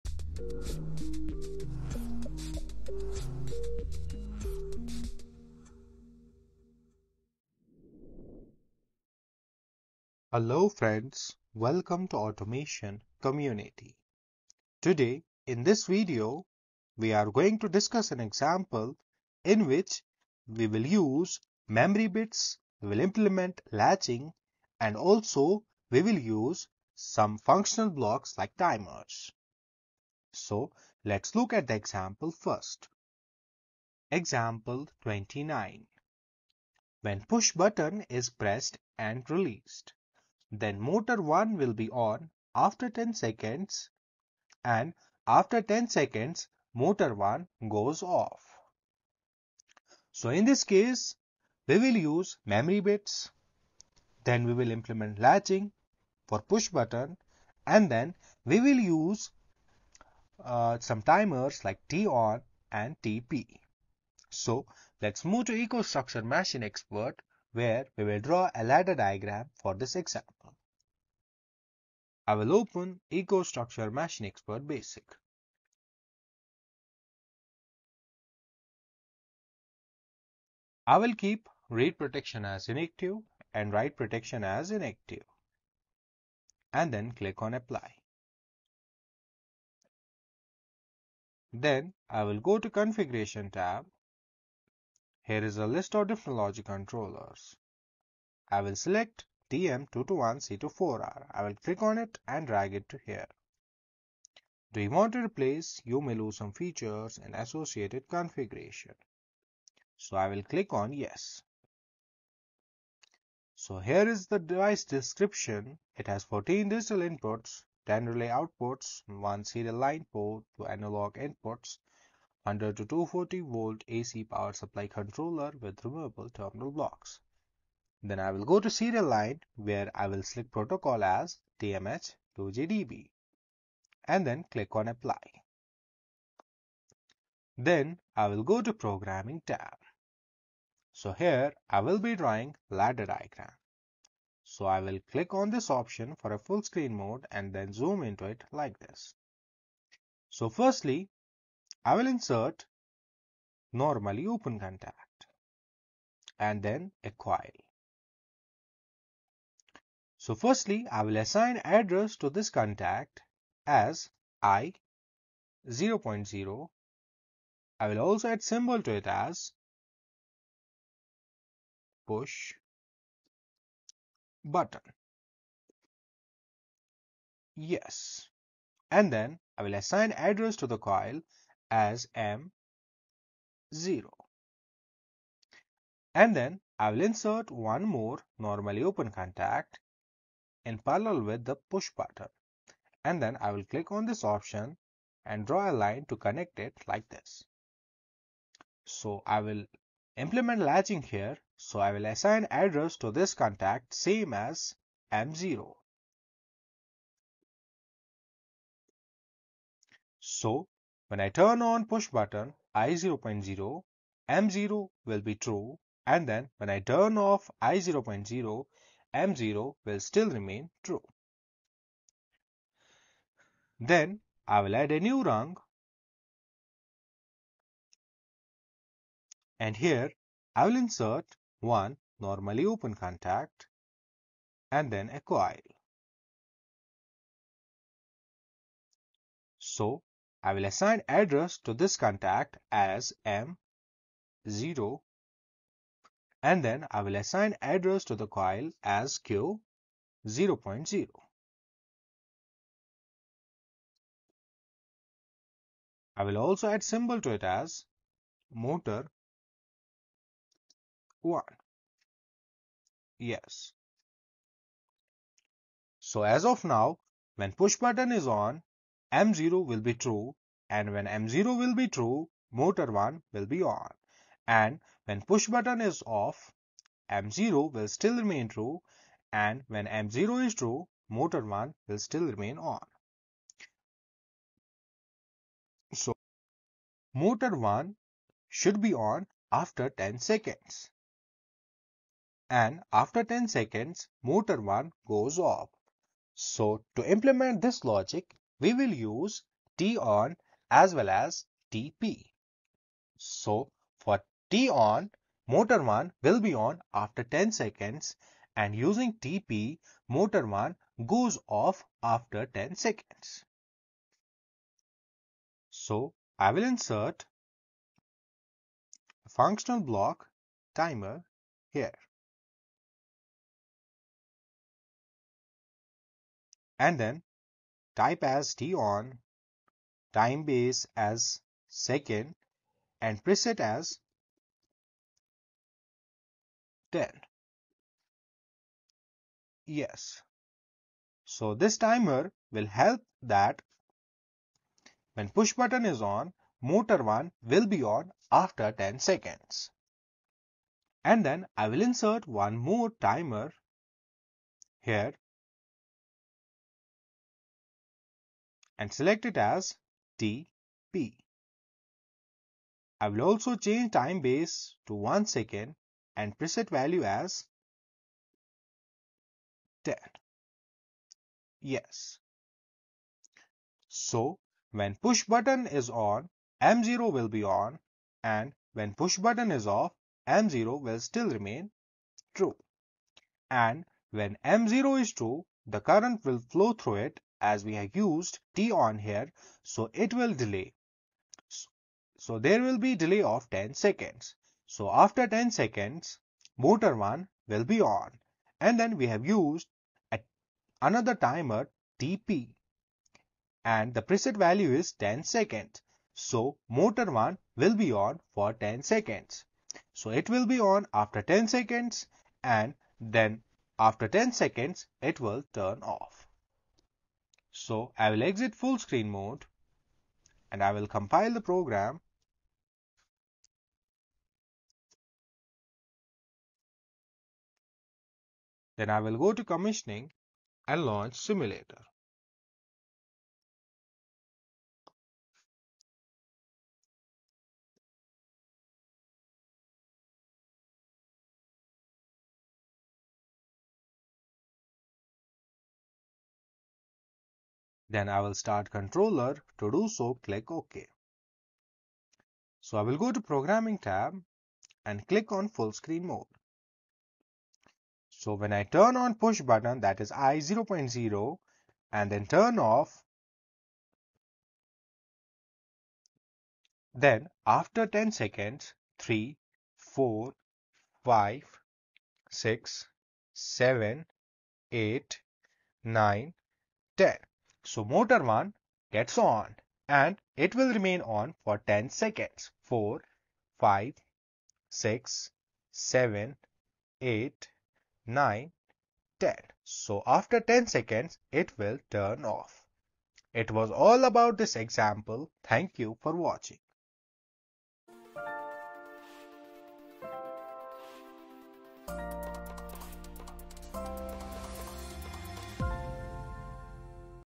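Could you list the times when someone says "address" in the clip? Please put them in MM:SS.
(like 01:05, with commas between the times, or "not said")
02:41, 03:00, 03:22, 04:01, 04:07.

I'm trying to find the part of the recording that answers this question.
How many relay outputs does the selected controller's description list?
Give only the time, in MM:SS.
01:57.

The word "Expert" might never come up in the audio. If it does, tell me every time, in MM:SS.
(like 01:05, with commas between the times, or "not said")
01:06, 01:14.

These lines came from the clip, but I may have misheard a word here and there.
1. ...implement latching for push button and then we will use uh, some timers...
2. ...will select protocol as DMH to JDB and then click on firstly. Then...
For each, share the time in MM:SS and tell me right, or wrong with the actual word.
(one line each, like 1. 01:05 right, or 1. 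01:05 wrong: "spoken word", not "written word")
1. 00:54 right
2. 02:10 wrong: "apply", not "firstly".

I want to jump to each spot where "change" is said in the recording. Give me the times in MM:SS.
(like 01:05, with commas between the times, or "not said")
06:03.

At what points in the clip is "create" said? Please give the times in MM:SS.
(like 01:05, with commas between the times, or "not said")
not said.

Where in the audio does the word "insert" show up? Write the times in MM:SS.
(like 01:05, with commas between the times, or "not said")
02:32, 03:07, 03:50, 05:16, 05:51.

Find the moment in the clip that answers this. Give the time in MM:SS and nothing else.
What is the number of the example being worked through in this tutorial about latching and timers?
00:34.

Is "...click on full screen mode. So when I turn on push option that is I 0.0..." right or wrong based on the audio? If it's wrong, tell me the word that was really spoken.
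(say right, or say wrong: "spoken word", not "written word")
wrong: "button", not "option".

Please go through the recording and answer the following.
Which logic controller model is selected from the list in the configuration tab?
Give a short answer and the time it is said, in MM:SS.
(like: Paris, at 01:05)
TM221C24R, at 01:39.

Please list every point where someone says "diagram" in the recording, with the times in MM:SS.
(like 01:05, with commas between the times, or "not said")
01:08, 02:23.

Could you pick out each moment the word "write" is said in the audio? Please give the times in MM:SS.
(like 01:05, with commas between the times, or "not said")
01:23.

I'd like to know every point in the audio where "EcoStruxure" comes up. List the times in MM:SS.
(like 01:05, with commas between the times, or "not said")
01:05, 01:13.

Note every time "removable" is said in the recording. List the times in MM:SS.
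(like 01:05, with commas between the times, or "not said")
02:05.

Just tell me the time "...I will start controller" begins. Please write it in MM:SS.
07:28.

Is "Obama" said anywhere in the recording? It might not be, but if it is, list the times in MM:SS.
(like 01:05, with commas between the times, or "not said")
not said.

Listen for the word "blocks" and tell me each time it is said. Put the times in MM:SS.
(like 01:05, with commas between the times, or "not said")
00:27, 02:06, 05:19.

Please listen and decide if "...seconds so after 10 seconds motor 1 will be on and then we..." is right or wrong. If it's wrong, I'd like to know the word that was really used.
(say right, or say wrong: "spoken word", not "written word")
right.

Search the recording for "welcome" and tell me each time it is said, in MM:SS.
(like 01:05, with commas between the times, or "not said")
00:11.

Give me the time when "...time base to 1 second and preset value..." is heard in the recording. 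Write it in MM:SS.
06:03.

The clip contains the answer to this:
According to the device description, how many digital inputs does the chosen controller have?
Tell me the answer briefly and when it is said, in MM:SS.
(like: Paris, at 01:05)
14, at 01:56.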